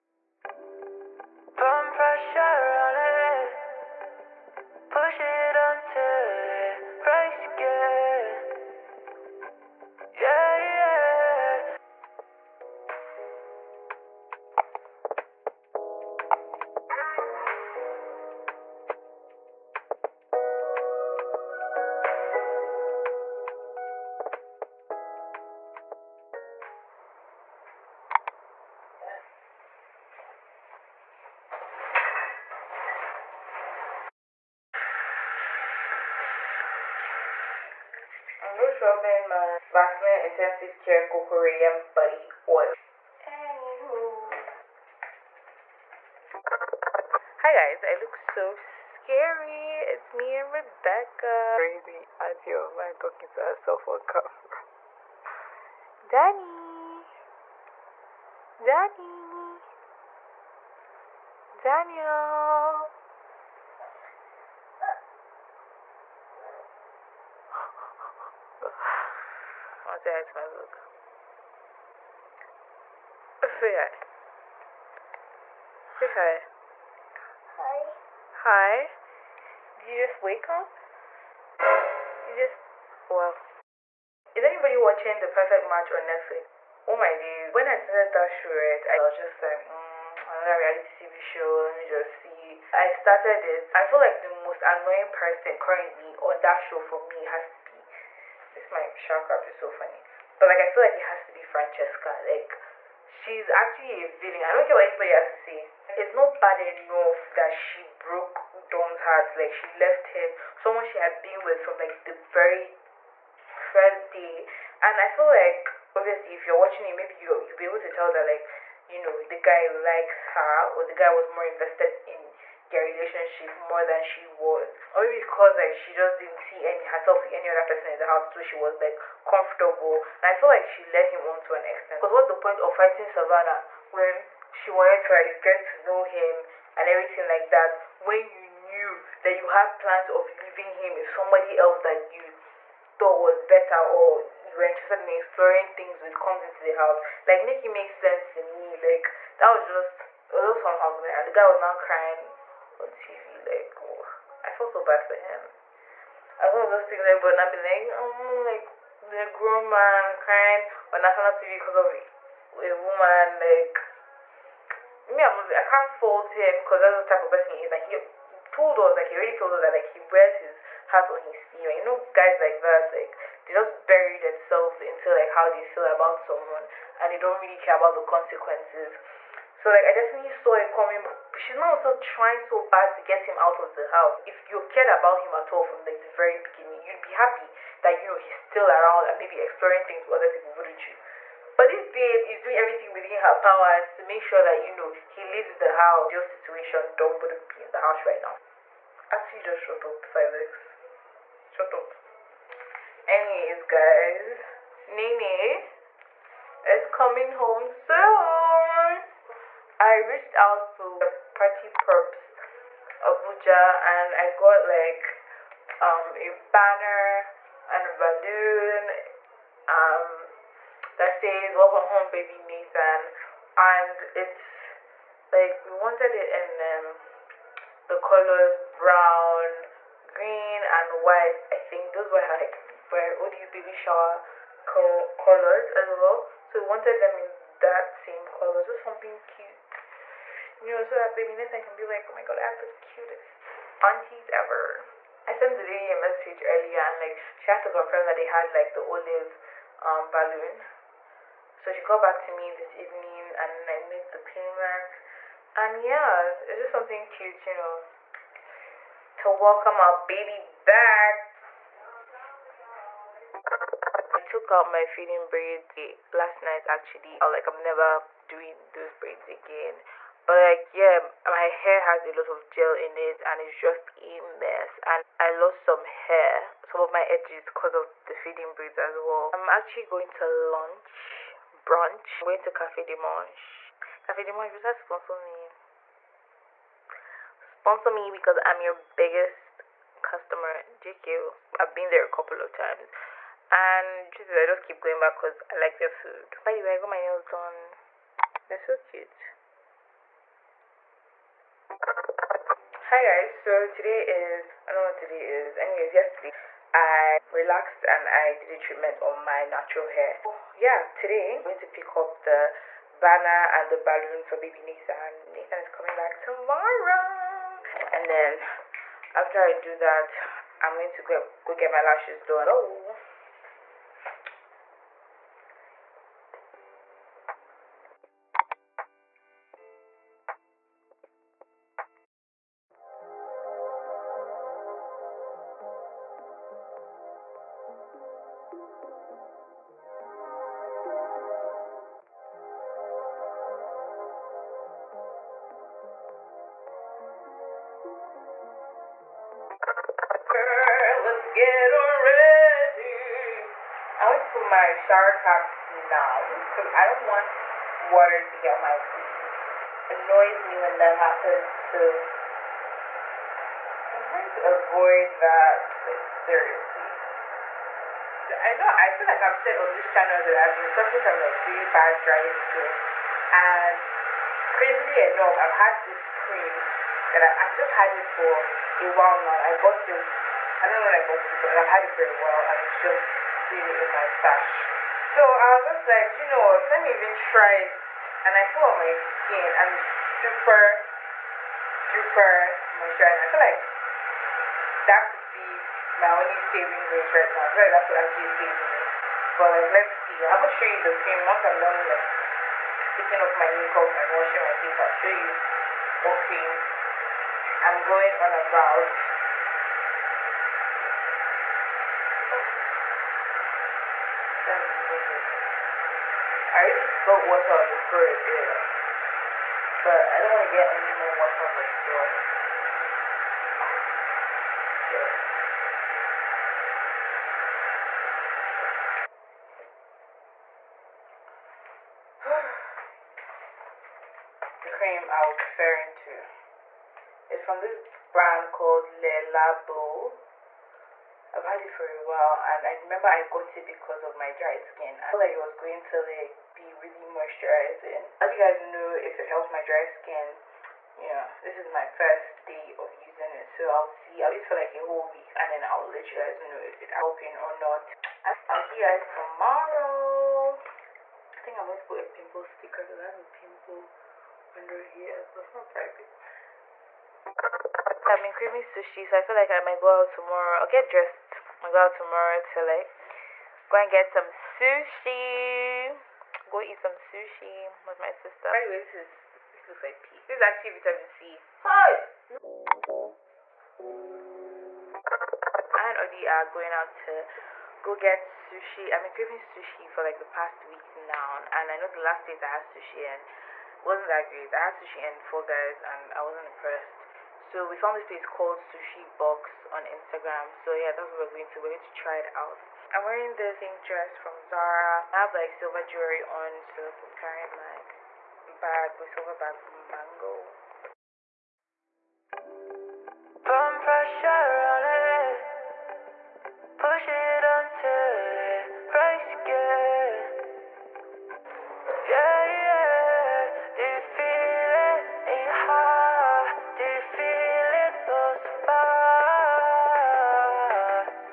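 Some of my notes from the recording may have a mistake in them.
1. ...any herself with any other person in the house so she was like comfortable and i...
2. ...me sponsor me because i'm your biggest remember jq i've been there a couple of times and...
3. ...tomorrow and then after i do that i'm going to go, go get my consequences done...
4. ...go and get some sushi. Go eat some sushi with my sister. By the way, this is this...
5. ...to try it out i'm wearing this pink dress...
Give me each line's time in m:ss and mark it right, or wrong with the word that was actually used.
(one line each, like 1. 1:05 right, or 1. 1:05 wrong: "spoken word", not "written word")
1. 2:06 right
2. 4:45 wrong: "customer", not "remember"
3. 5:16 wrong: "lashes", not "consequences"
4. 7:53 right
5. 8:21 right.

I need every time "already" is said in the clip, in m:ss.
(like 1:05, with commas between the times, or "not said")
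2:49, 6:56.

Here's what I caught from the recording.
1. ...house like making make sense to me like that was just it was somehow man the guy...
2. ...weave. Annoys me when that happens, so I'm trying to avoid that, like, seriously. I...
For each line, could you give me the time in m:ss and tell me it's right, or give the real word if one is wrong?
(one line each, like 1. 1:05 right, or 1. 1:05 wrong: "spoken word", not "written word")
1. 2:26 right
2. 5:58 right.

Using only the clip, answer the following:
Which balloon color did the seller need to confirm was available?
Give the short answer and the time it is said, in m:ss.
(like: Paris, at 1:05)
Olive, at 4:08.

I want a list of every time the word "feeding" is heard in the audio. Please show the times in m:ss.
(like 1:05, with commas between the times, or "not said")
4:24, 4:38.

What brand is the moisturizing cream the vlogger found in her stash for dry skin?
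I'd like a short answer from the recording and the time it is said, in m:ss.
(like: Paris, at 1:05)
Le Labo, at 7:18.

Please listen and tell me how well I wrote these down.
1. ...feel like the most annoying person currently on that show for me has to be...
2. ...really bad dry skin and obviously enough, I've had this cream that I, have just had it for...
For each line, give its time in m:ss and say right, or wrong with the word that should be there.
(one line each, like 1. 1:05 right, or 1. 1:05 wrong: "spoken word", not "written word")
1. 1:33 right
2. 6:11 wrong: "crazily", not "obviously".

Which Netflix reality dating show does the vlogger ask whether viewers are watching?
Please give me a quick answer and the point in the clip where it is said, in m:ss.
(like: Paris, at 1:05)
The Perfect Match, at 1:25.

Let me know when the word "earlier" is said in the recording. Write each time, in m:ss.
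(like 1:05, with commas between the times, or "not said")
4:06.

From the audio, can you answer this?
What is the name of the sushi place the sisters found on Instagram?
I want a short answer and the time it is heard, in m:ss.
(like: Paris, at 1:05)
Sushi Box, at 8:18.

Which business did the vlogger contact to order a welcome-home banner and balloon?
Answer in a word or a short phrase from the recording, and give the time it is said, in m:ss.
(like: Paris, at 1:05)
Party Props Abuja, at 3:31.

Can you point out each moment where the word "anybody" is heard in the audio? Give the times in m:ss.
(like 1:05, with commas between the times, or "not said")
1:24, 1:44.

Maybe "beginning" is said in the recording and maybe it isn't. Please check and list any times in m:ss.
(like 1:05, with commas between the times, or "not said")
3:06.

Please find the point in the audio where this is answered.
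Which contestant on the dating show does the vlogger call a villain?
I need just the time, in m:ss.
1:41.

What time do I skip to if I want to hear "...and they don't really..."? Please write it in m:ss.
2:56.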